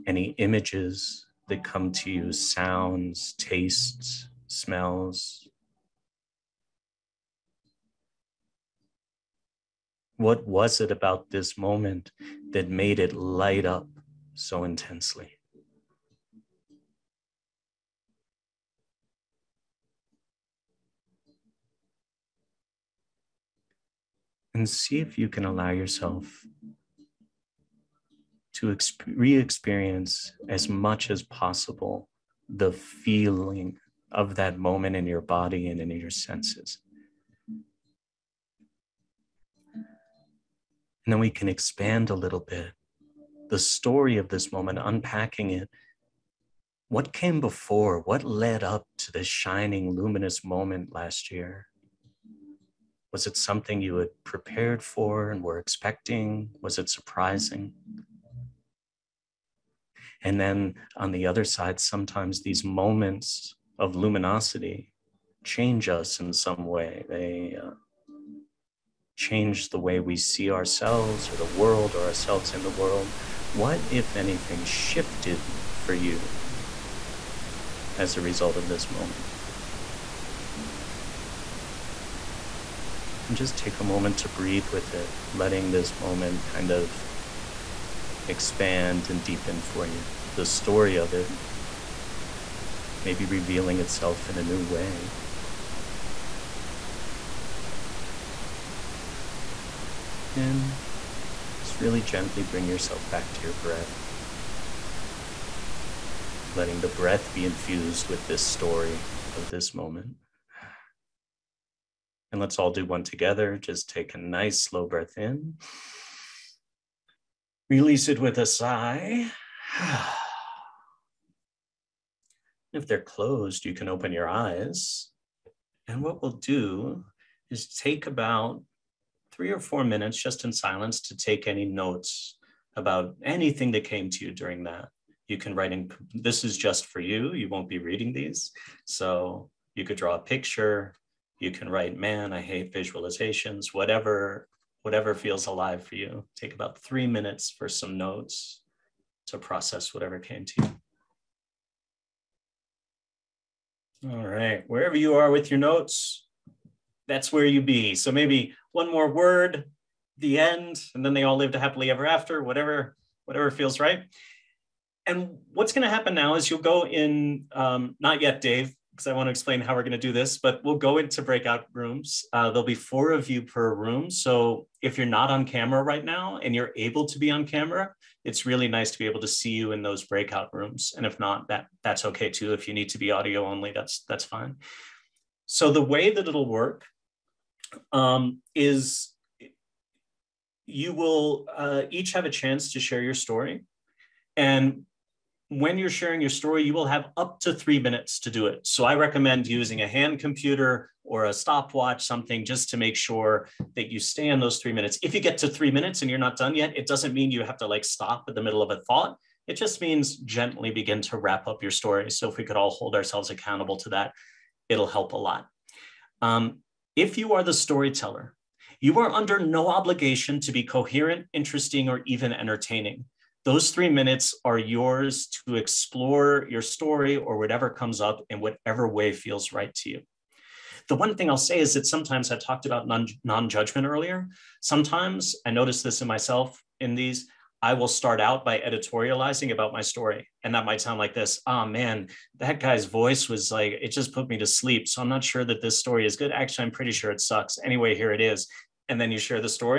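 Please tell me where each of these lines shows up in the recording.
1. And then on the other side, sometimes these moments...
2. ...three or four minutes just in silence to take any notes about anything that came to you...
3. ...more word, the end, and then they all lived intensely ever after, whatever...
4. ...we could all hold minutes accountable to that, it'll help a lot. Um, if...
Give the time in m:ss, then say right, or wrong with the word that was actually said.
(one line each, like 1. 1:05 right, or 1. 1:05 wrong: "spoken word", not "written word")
1. 1:00 right
2. 2:09 right
3. 2:38 wrong: "happily", not "intensely"
4. 3:32 wrong: "ourselves", not "minutes".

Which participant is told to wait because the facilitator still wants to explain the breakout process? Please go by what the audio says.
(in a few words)
Dave.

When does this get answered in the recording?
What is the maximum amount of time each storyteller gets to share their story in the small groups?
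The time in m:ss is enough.
3:17.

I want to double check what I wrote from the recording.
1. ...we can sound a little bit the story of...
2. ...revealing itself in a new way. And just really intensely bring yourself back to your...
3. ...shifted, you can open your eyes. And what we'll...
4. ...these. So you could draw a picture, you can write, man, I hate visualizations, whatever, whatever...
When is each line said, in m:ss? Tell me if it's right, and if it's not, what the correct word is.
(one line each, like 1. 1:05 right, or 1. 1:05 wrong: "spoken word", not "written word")
1. 0:41 wrong: "expand", not "sound"
2. 1:33 wrong: "gently", not "intensely"
3. 2:03 wrong: "closed", not "shifted"
4. 2:18 right.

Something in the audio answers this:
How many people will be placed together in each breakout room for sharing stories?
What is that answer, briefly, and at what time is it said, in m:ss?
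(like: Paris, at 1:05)
4, at 2:52.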